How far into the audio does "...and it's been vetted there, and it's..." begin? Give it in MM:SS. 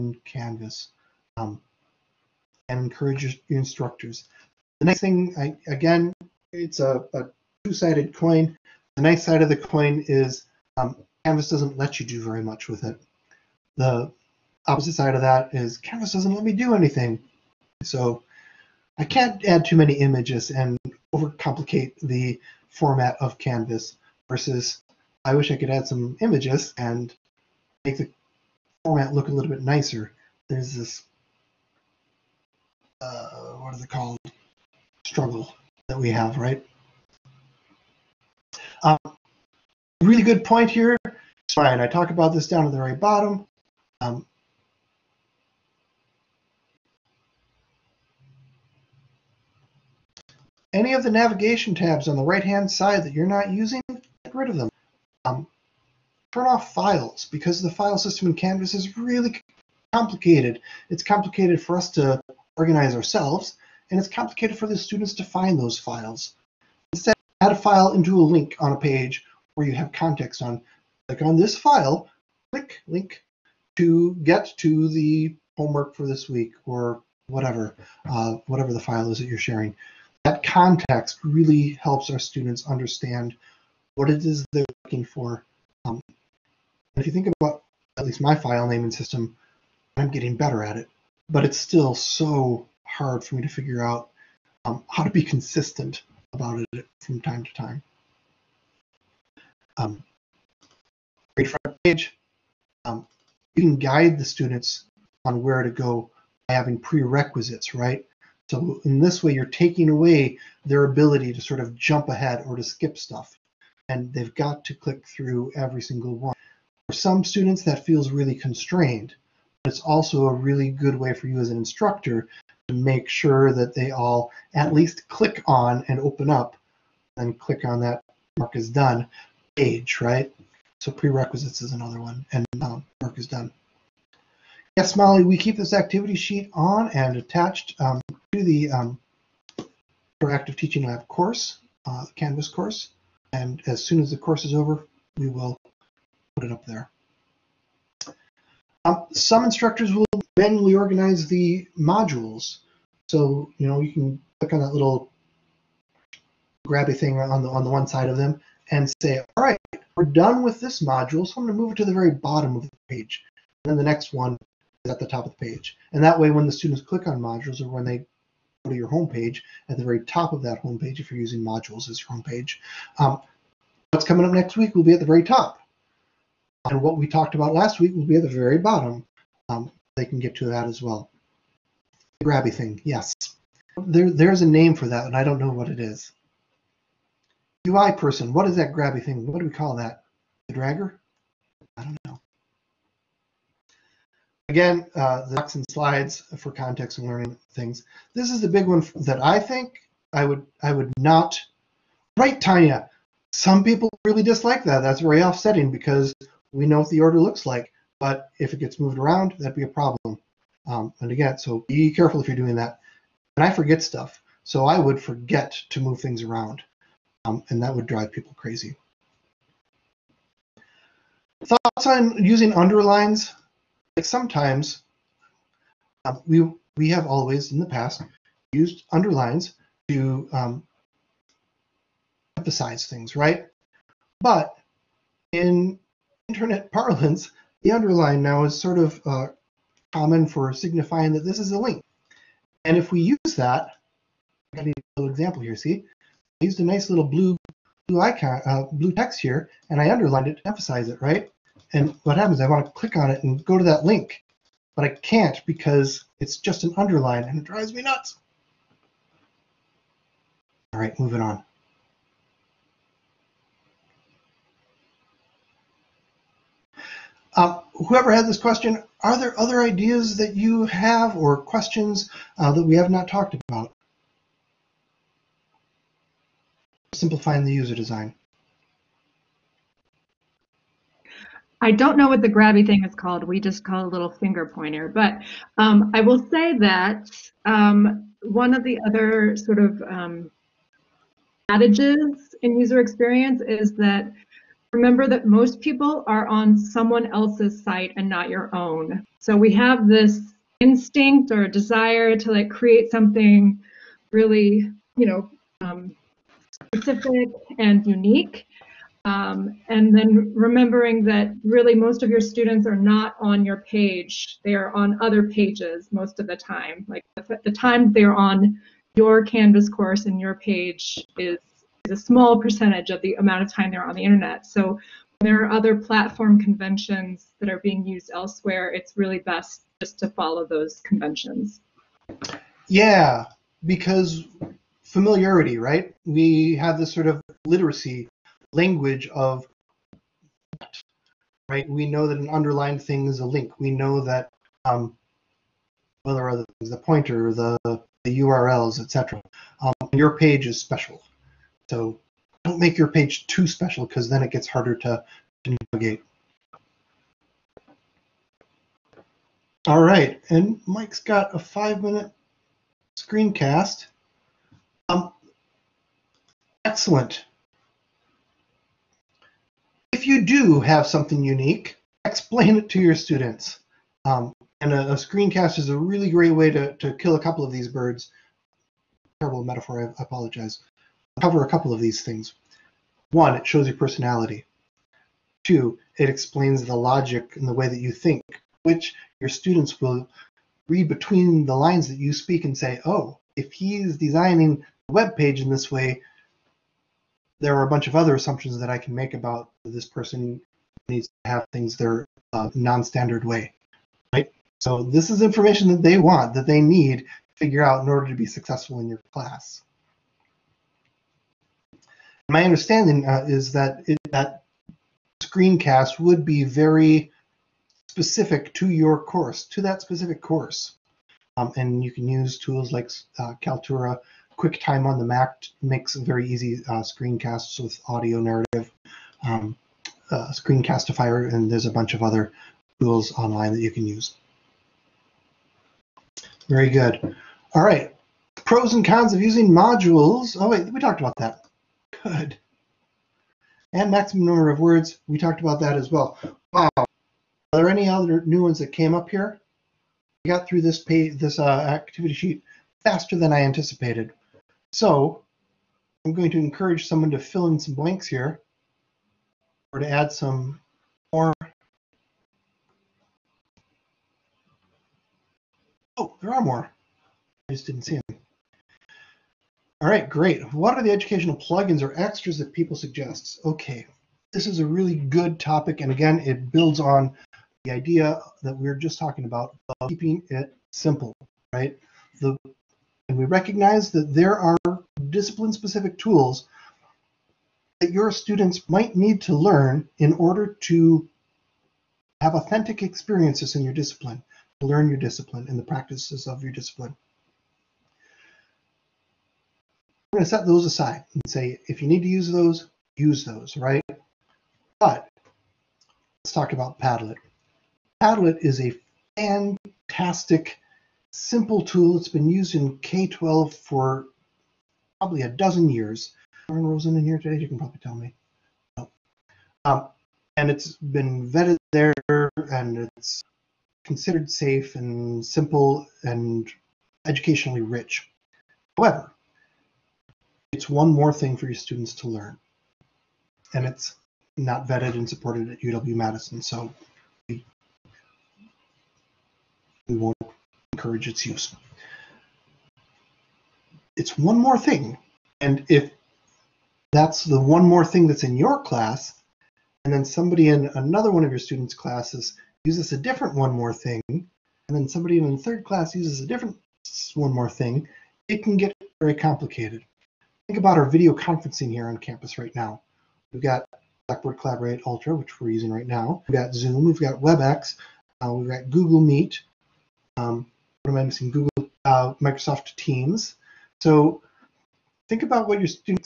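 08:40.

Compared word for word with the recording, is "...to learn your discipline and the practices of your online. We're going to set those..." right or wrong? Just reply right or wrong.
wrong.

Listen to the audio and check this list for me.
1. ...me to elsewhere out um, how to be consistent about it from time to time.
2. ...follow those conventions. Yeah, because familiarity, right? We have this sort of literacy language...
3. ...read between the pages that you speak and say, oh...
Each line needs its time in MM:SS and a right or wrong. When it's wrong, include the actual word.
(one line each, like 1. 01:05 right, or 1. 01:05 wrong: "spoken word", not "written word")
1. 01:33 wrong: "figure", not "elsewhere"
2. 05:30 right
3. 06:30 wrong: "lines", not "pages".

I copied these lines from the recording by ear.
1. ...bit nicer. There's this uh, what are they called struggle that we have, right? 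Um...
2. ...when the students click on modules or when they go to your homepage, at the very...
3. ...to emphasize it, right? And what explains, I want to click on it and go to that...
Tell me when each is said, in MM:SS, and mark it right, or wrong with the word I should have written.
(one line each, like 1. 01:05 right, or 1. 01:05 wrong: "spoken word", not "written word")
1. 00:29 right
2. 02:46 right
3. 04:10 wrong: "happens", not "explains".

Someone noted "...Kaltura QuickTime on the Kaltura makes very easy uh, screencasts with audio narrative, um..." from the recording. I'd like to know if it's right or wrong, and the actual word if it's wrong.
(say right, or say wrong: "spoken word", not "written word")
wrong: "Mac", not "Kaltura".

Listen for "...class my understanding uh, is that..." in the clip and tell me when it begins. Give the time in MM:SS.
06:49.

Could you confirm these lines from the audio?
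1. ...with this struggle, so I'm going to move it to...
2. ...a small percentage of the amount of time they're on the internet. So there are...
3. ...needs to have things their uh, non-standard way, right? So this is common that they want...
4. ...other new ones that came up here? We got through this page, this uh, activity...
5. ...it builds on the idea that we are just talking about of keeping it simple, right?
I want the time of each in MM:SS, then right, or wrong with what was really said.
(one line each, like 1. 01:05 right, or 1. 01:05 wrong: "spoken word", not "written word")
1. 02:40 wrong: "module", not "struggle"
2. 05:21 right
3. 06:40 wrong: "information", not "common"
4. 07:27 right
5. 07:56 right.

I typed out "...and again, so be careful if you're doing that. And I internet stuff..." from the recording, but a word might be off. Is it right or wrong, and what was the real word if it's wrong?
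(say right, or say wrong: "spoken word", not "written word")
wrong: "forget", not "internet".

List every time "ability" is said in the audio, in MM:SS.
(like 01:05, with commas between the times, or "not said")
01:50.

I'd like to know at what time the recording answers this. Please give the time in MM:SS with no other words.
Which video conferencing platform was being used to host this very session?
09:24.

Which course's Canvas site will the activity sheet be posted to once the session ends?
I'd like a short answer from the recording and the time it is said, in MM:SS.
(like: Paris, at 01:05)
Interactive Teaching Lab, at 02:20.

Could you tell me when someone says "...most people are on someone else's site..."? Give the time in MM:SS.
04:55.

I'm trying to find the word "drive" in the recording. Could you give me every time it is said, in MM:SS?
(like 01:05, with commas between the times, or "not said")
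03:37, 04:17.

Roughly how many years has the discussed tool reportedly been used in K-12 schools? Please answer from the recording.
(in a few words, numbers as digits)
A dozen.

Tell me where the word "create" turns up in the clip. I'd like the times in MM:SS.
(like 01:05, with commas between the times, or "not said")
05:02.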